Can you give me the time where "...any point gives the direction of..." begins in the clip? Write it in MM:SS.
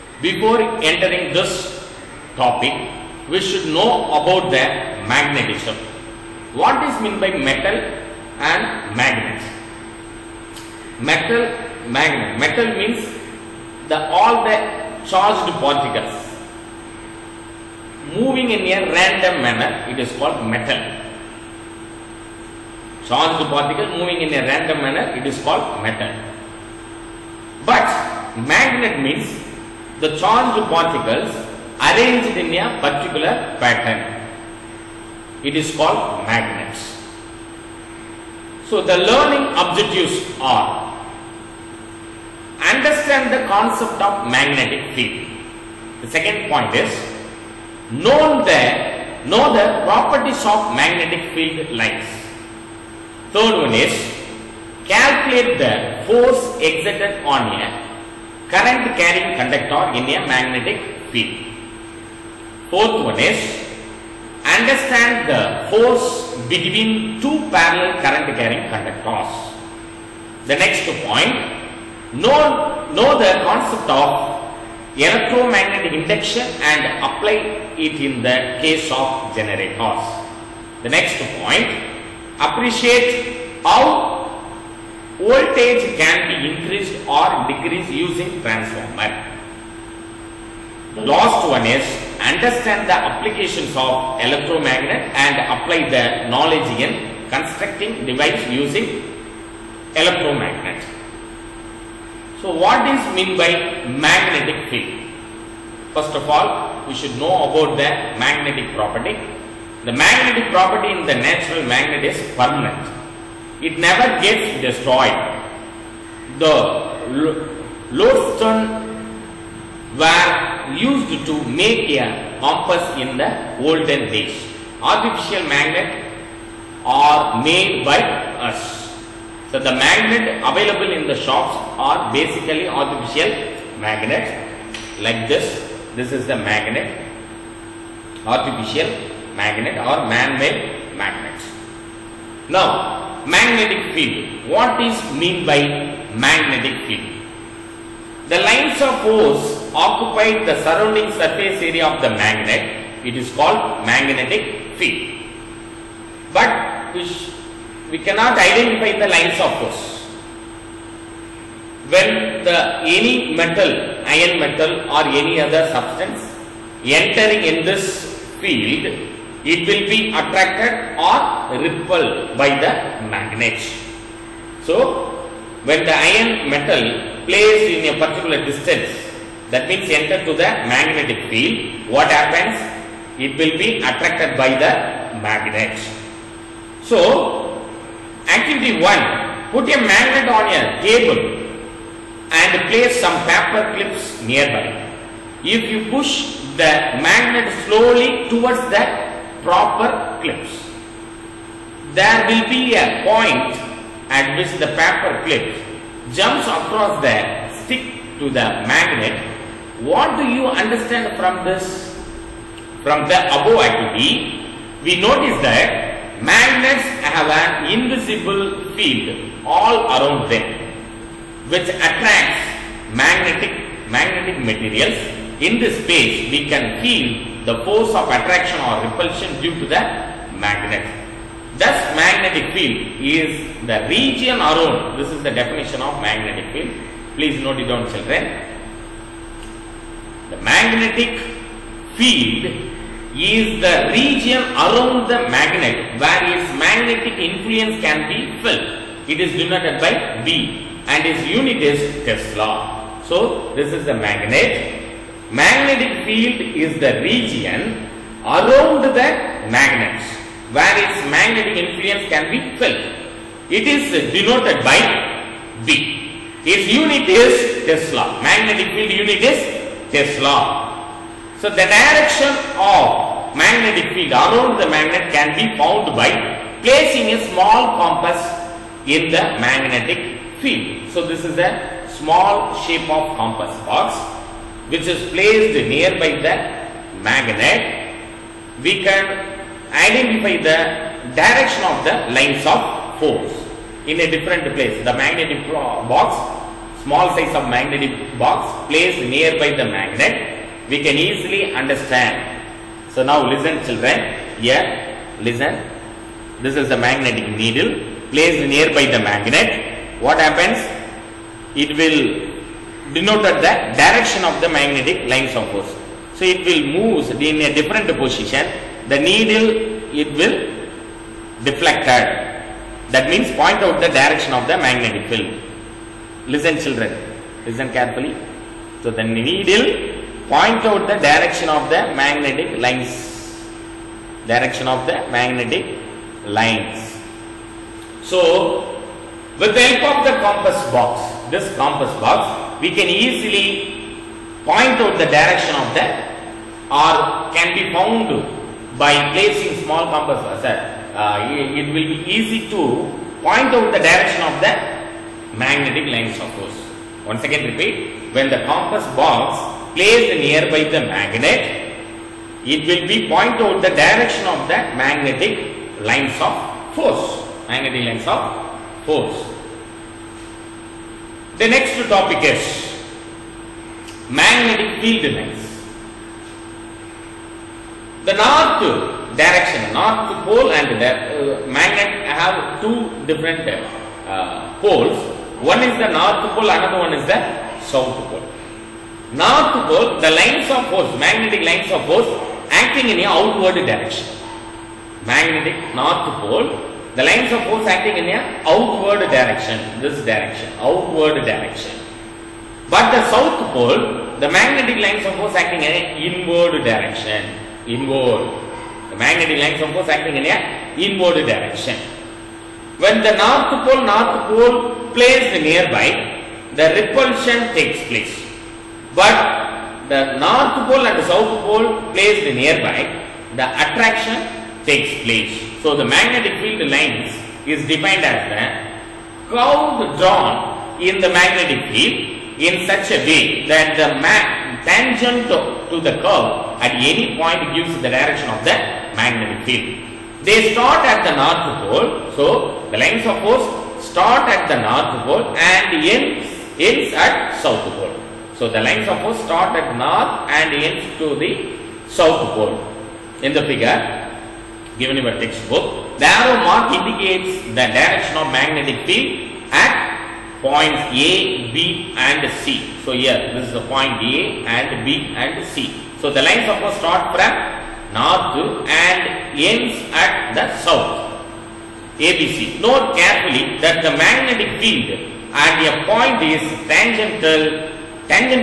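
07:16.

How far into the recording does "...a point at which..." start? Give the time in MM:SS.
03:22.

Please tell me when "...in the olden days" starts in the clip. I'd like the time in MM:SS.
02:02.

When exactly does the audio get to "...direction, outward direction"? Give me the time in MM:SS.
06:40.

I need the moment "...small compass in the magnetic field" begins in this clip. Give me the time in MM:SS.
04:37.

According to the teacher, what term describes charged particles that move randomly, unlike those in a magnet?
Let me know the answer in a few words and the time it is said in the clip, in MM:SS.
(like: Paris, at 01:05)
Matter, at 00:25.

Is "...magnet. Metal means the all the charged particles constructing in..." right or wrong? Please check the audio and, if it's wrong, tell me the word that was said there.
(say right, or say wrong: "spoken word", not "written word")
wrong: "moving", not "constructing".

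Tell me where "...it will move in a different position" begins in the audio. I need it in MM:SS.
05:16.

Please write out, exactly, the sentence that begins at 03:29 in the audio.
What do you understand from this?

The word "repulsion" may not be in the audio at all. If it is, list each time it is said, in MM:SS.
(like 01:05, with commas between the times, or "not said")
03:48, 06:56.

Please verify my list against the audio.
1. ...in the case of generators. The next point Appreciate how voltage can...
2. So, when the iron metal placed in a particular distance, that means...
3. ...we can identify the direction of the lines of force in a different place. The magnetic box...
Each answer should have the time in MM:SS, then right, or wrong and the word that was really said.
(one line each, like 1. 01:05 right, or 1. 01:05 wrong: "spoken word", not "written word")
1. 01:17 right
2. 02:54 right
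3. 04:48 right.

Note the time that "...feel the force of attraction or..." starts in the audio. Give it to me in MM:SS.
03:46.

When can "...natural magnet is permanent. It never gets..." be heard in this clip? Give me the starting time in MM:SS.
01:51.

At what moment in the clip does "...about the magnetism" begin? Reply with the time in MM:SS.
00:04.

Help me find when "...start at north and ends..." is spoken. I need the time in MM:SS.
07:29.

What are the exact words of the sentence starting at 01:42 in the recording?
So what is mean by magnetic field?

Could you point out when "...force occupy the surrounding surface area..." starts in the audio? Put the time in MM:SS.
02:29.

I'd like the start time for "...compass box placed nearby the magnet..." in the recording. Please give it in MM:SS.
05:58.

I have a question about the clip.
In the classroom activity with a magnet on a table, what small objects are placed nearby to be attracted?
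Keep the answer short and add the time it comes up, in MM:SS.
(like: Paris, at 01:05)
Paper clips, at 03:13.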